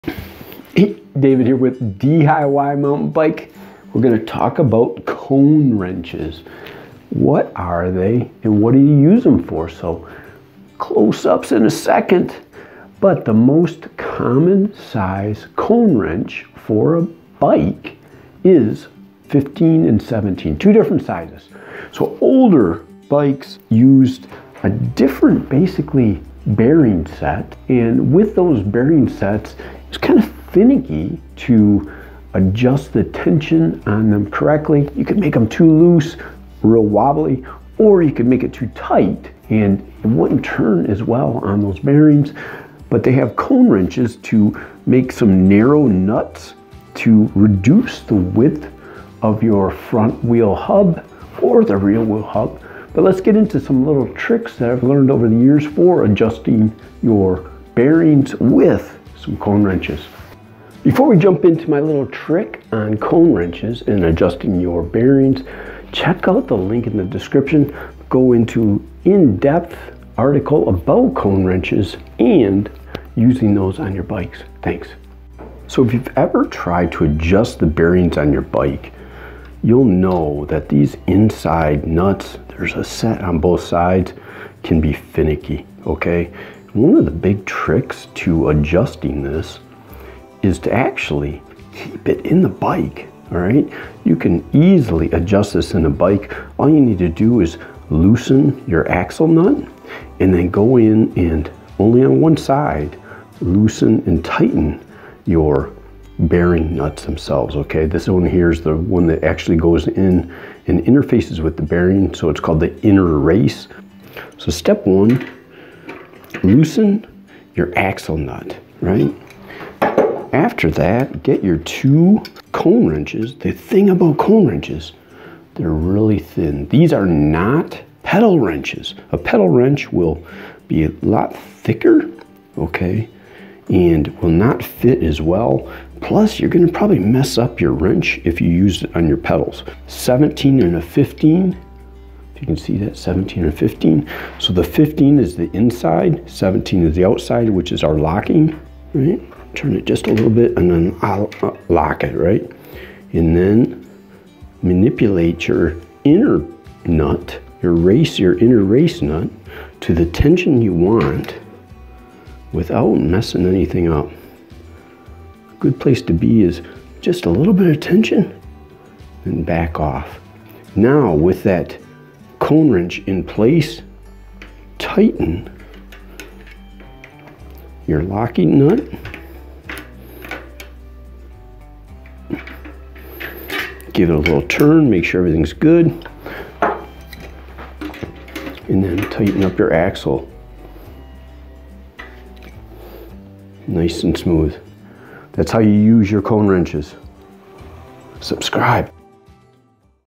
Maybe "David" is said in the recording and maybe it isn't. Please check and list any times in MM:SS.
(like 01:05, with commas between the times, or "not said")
00:00.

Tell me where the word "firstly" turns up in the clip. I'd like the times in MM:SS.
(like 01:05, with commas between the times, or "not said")
not said.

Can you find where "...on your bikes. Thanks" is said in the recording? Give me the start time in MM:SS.
01:13.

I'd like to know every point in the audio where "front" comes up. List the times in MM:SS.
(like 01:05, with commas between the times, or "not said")
00:49.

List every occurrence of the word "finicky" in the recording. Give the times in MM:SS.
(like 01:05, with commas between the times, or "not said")
00:30, 01:24.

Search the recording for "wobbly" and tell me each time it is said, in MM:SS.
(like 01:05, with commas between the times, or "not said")
00:36.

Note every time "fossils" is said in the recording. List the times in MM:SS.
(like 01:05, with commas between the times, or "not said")
not said.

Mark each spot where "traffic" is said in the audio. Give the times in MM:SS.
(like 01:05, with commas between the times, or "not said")
not said.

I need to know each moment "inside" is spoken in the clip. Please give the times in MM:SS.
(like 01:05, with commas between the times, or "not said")
01:21, 02:25.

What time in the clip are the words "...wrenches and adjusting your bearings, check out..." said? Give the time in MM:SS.
01:03.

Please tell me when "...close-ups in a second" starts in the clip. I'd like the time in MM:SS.
00:10.